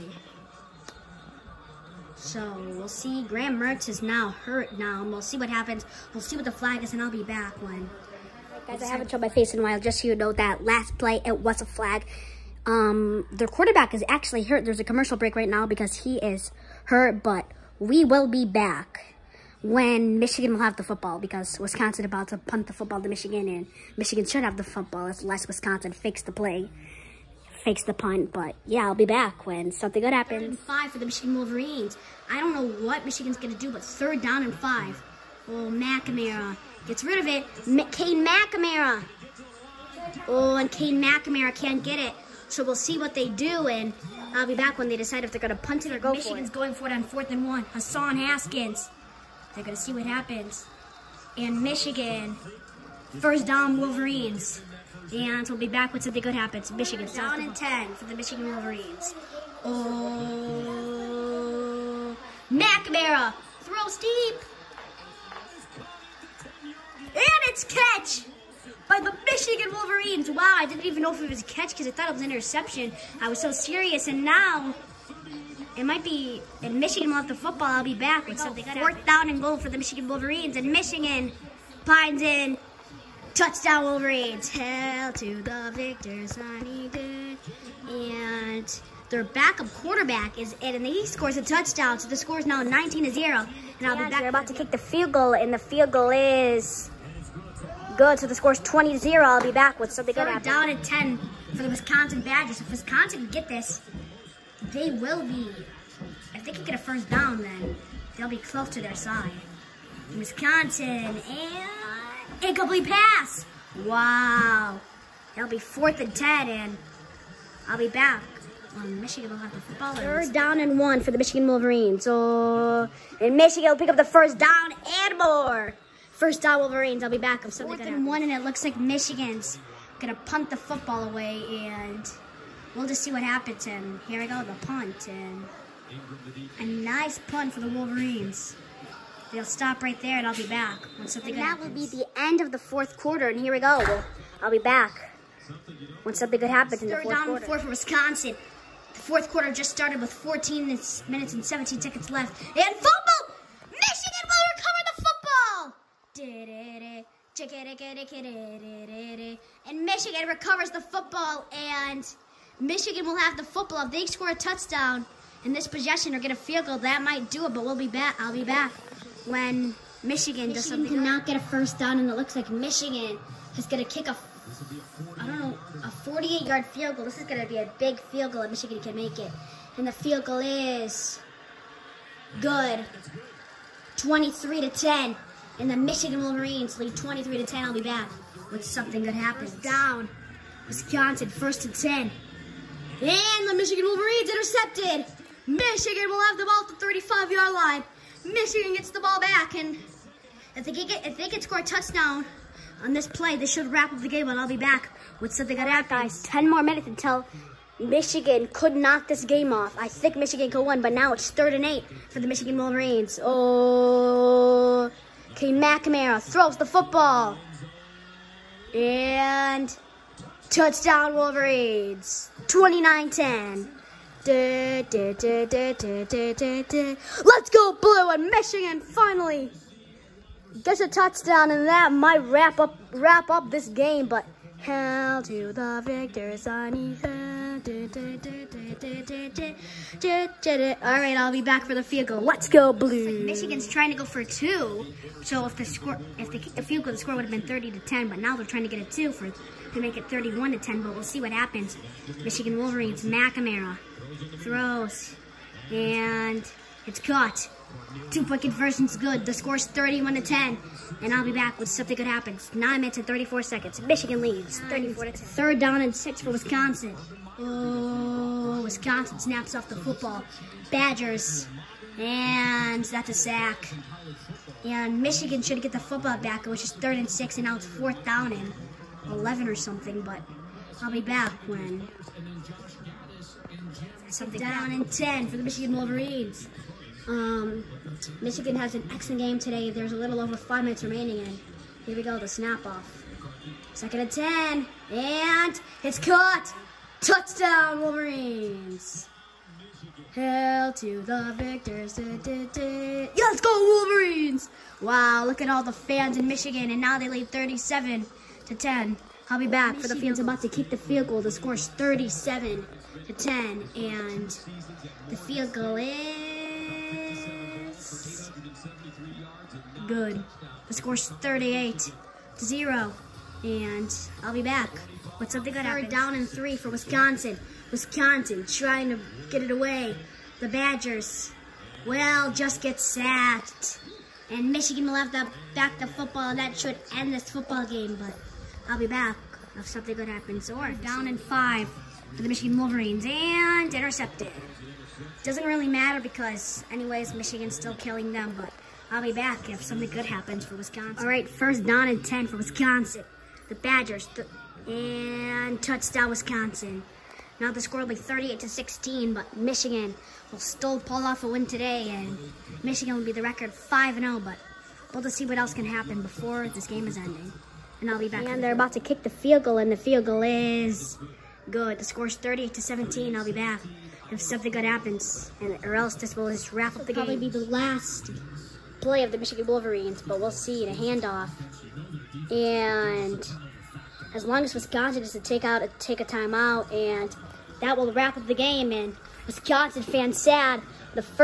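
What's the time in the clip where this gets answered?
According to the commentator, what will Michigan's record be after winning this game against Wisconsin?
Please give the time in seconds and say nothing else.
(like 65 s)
363 s.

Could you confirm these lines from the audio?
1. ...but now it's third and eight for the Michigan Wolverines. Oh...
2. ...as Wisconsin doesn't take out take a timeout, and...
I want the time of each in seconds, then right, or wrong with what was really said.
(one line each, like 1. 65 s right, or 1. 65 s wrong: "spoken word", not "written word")
1. 210 s right
2. 384 s right.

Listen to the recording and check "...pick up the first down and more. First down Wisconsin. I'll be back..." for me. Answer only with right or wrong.
wrong.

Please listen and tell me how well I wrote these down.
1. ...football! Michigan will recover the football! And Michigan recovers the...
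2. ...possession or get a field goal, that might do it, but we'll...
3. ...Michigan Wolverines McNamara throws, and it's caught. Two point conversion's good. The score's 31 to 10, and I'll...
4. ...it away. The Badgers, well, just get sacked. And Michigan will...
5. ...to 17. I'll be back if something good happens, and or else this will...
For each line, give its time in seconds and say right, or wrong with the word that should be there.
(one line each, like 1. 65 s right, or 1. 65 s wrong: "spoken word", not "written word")
1. 152 s right
2. 165 s right
3. 252 s right
4. 329 s right
5. 372 s right.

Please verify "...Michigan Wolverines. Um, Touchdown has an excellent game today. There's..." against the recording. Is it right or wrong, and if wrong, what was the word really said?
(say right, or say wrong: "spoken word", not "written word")
wrong: "Michigan", not "Touchdown".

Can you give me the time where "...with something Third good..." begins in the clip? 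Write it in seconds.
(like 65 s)
99 s.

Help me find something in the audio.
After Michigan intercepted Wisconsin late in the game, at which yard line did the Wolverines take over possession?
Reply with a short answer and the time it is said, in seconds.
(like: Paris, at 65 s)
35-yard line, at 196 s.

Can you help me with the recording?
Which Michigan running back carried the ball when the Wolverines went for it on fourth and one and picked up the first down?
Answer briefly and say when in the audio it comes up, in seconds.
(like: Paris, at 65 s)
Hassan Haskins, at 47 s.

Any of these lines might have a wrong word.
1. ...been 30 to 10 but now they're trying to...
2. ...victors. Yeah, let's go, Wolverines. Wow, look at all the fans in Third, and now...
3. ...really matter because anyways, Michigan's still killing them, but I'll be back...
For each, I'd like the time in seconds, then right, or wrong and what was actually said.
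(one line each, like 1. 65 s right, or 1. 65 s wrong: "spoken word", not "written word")
1. 247 s right
2. 301 s wrong: "Michigan", not "Third"
3. 345 s right.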